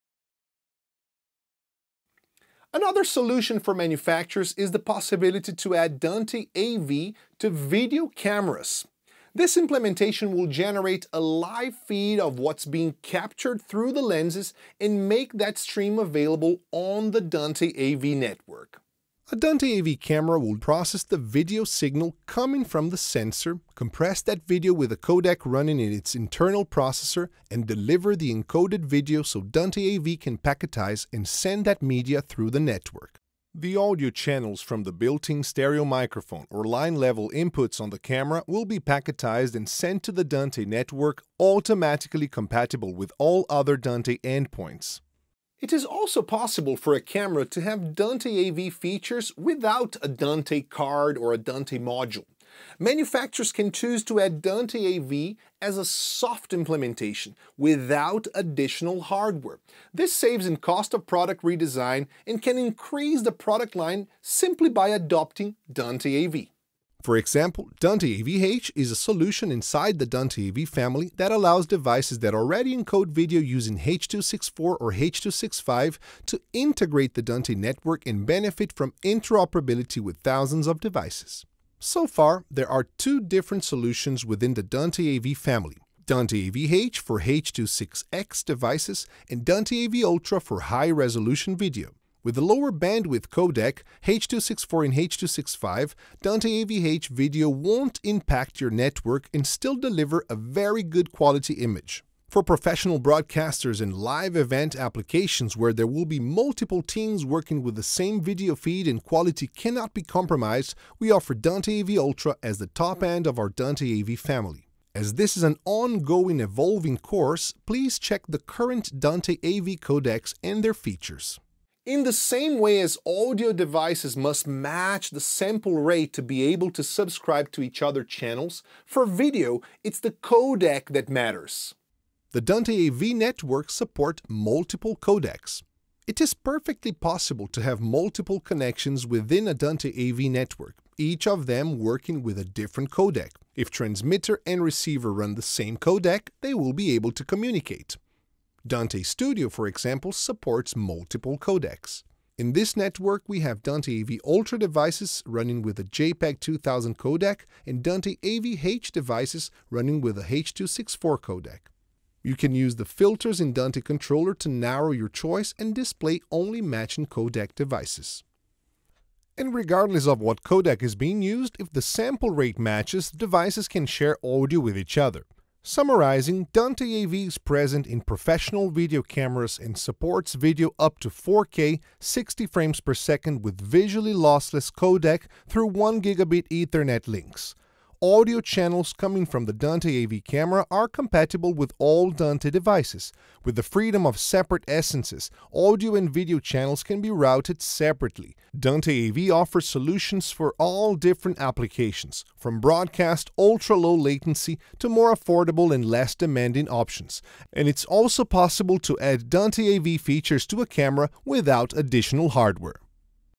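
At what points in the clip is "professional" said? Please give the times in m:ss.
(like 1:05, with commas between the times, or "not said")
1:42, 2:58.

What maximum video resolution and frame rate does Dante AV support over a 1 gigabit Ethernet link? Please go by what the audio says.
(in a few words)
4K 60 frames per second.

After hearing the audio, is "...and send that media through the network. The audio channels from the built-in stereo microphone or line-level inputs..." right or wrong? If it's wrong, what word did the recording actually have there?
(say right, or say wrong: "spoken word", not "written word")
right.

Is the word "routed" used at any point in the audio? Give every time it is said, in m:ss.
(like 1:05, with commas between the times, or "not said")
3:17.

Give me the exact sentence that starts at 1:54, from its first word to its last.
As this is an ongoing evolving course, please check the current Dante AV codecs and their features.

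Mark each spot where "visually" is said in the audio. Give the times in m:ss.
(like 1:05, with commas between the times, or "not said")
3:03.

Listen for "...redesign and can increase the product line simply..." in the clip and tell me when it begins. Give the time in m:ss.
1:01.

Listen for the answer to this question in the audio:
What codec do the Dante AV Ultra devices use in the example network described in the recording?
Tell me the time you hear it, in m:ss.
2:35.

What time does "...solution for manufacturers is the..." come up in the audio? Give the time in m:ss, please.
0:03.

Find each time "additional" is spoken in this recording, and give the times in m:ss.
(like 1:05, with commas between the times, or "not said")
0:58, 3:31.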